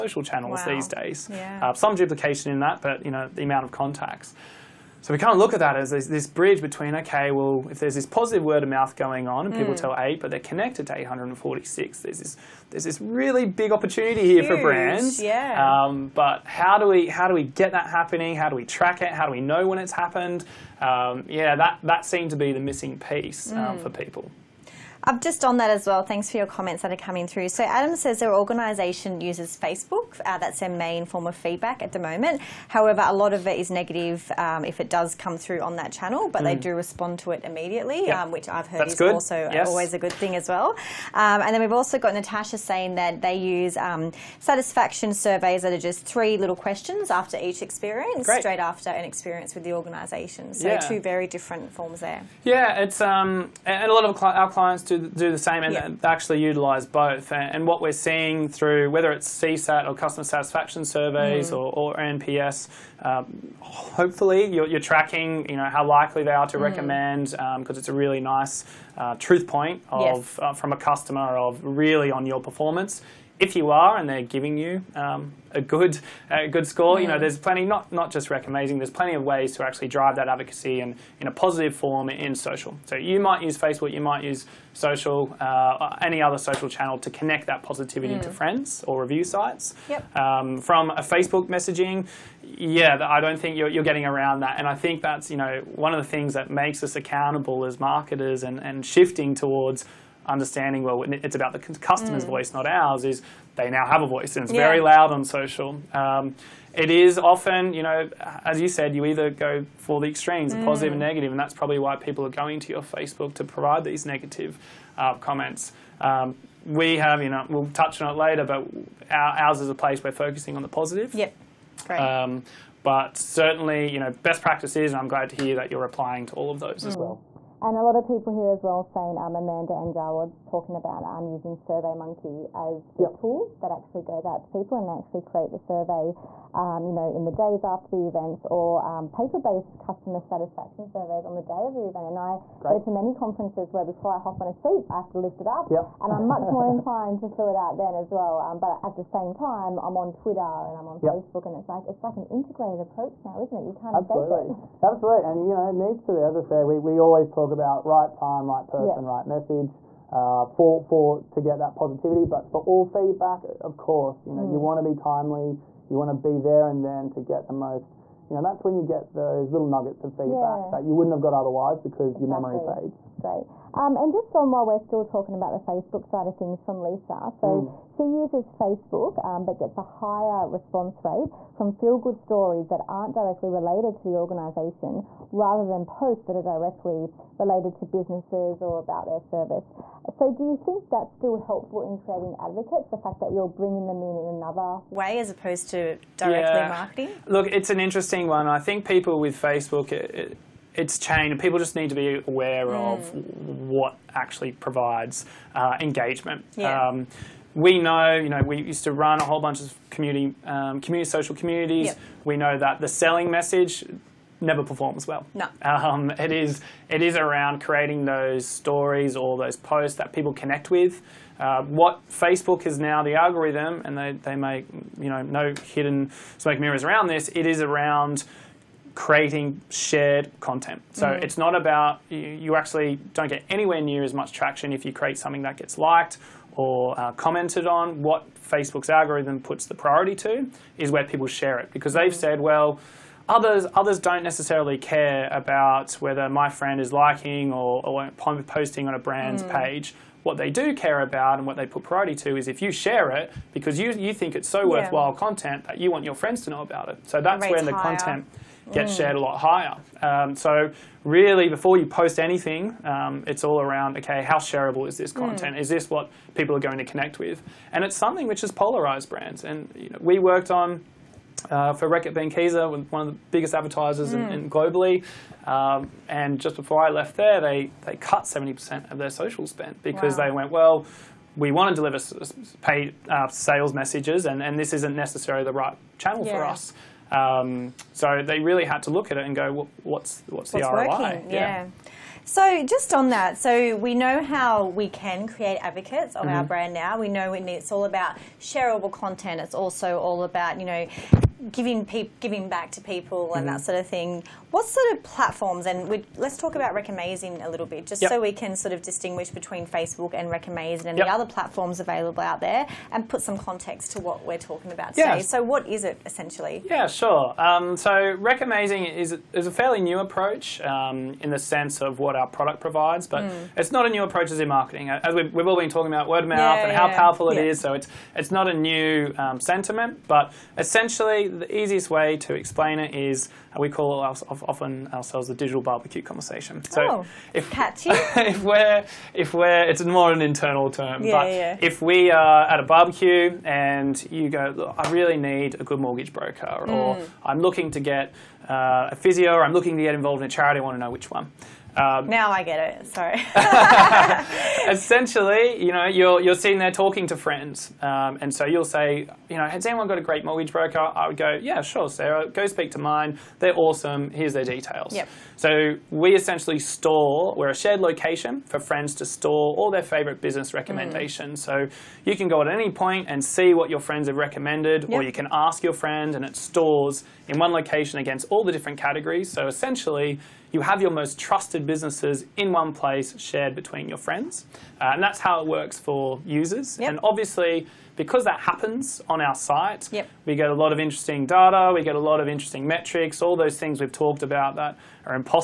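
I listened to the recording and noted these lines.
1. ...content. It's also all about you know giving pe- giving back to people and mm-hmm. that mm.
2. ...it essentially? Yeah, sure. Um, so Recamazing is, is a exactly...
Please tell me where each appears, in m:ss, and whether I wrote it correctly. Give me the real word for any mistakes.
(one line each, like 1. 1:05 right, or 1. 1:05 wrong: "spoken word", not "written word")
1. 4:58 right
2. 5:15 wrong: "fairly", not "exactly".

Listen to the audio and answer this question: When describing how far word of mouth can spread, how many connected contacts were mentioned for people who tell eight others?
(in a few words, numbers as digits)
846.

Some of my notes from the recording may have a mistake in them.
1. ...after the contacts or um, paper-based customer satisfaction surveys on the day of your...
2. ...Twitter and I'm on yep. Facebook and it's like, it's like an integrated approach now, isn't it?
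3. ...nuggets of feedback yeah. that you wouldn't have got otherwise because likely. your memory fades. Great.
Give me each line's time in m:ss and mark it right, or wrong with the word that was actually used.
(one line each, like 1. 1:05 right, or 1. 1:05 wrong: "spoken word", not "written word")
1. 2:17 wrong: "events", not "contacts"
2. 2:30 right
3. 2:49 wrong: "exactly", not "likely".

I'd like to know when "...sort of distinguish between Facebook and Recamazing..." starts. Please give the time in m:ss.
5:08.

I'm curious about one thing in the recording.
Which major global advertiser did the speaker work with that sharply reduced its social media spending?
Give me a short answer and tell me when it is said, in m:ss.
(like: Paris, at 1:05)
Reckitt Benckiser, at 4:31.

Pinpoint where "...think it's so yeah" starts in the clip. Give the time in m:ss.
4:14.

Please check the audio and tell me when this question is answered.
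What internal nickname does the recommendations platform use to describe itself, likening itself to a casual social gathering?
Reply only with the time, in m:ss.
5:35.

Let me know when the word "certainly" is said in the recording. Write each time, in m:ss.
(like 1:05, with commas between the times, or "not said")
2:03.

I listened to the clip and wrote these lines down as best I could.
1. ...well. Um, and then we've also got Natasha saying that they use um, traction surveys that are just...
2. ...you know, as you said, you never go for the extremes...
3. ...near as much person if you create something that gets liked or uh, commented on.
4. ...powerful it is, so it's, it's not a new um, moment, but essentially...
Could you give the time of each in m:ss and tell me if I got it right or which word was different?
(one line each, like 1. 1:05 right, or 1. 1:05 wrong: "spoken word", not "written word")
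1. 0:40 wrong: "satisfaction", not "traction"
2. 1:47 wrong: "either", not "never"
3. 3:53 wrong: "traction", not "person"
4. 5:26 wrong: "sentiment", not "moment".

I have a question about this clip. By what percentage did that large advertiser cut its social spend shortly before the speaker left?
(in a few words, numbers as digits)
70%.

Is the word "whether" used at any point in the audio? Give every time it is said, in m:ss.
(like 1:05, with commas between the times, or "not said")
0:58, 4:05.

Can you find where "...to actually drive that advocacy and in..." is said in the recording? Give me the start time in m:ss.
1:19.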